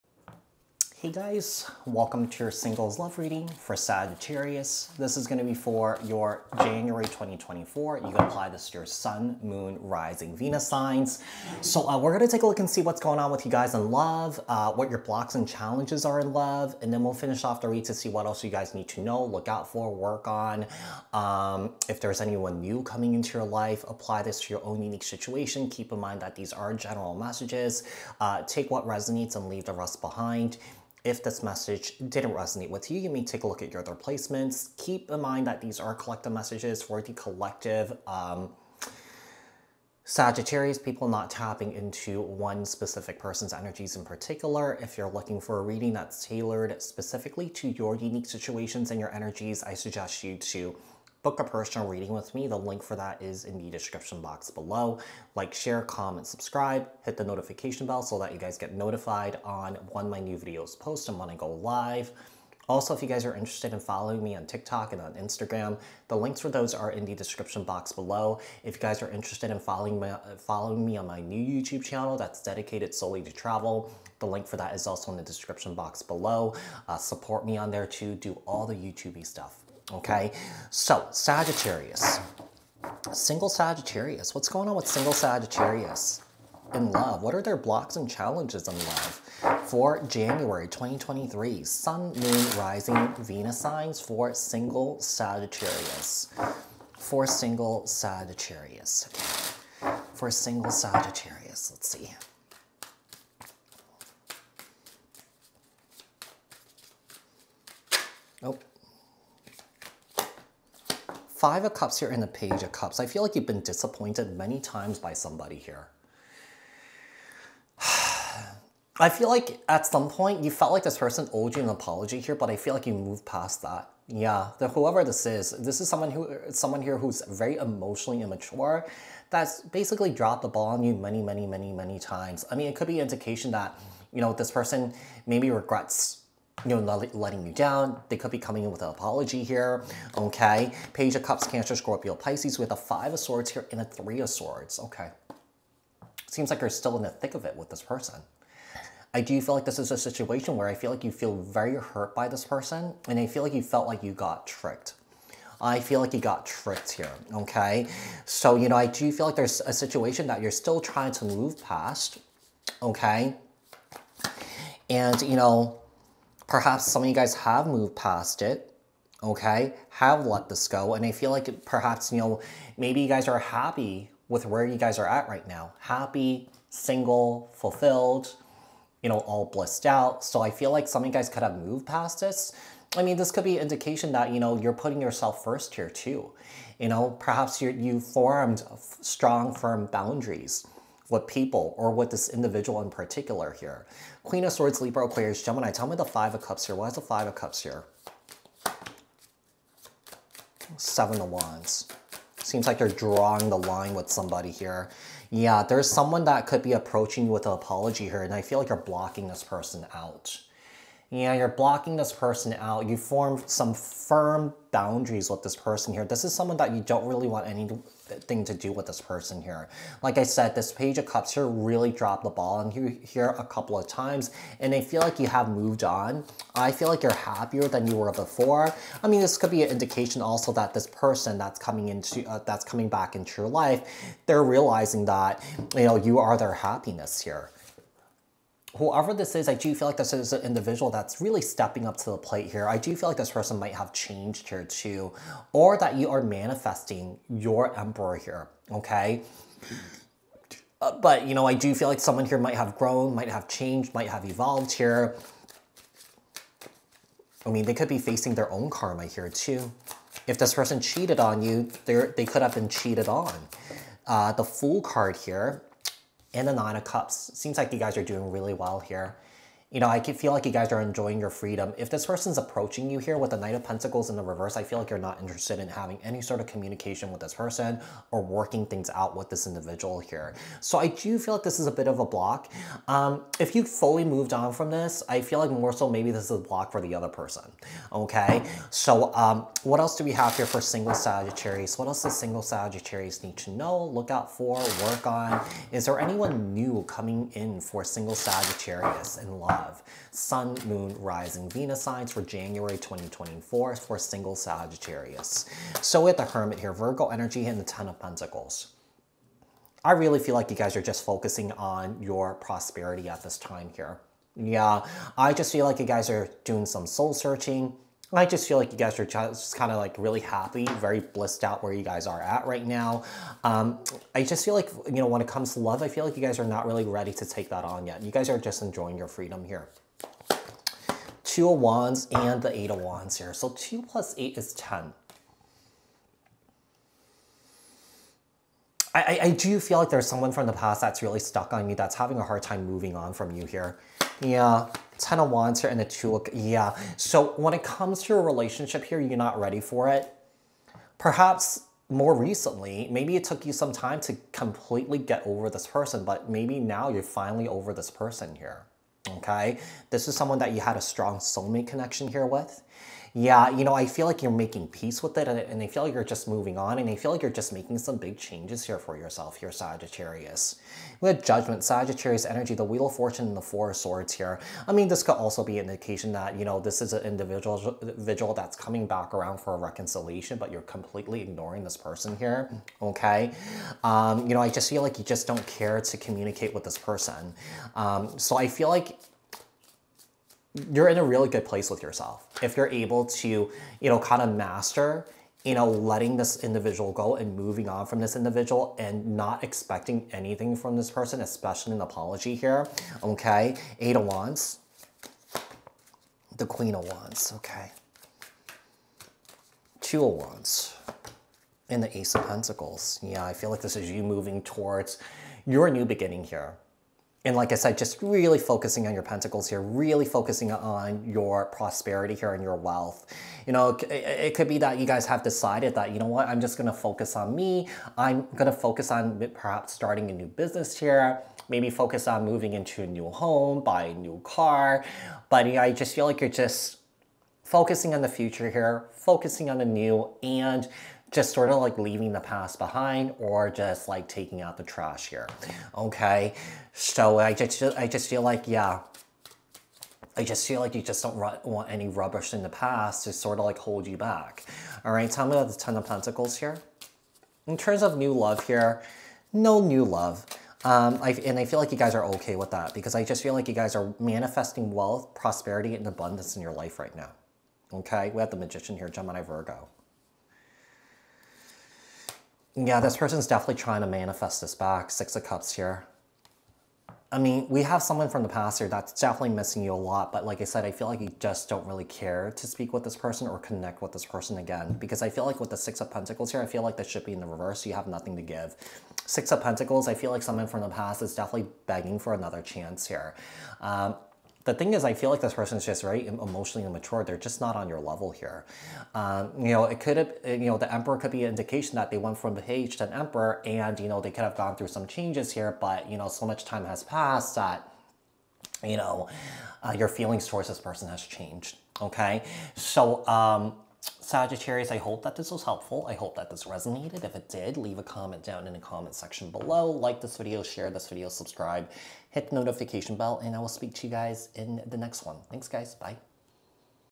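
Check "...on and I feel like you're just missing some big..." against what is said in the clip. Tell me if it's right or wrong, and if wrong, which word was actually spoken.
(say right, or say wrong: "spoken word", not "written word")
wrong: "making", not "missing".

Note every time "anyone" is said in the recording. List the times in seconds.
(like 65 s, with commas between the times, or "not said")
22 s, 295 s.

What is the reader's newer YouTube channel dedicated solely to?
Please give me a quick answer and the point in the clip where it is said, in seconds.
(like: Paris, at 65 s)
Travel, at 73 s.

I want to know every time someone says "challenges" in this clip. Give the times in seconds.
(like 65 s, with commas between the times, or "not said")
15 s, 88 s.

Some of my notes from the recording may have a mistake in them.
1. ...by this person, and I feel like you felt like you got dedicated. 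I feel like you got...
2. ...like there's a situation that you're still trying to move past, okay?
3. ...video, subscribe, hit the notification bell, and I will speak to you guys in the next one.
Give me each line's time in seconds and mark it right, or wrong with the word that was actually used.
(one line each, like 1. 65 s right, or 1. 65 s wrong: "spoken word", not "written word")
1. 152 s wrong: "tricked", not "dedicated"
2. 159 s right
3. 520 s right.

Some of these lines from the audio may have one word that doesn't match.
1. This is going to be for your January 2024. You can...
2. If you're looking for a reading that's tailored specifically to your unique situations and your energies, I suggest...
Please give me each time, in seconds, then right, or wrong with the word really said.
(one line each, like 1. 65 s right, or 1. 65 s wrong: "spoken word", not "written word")
1. 4 s right
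2. 44 s right.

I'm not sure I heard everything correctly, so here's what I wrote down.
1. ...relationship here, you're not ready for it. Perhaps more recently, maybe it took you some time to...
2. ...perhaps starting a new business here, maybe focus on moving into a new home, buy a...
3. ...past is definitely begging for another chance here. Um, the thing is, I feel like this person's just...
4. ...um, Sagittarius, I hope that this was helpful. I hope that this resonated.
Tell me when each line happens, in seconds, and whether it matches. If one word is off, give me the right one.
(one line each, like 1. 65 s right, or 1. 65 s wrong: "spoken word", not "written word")
1. 348 s right
2. 429 s right
3. 490 s right
4. 513 s right.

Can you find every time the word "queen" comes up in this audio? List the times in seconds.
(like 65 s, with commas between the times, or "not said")
194 s, 406 s.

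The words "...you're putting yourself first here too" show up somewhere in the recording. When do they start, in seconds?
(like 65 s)
184 s.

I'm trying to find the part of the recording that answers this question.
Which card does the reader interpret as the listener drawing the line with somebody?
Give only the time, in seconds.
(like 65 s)
200 s.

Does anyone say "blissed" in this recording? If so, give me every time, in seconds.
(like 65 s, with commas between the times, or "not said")
179 s, 320 s.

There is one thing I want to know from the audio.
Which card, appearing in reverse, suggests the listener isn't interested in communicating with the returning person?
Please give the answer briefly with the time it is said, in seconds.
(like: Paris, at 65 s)
Knight of Pentacles, at 273 s.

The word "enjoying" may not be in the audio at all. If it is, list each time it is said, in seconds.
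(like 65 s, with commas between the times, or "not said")
270 s, 328 s.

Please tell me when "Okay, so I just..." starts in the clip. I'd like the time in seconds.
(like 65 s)
445 s.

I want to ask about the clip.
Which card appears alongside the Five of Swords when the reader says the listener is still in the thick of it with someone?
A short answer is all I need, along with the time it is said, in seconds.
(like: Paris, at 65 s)
Three of Swords, at 143 s.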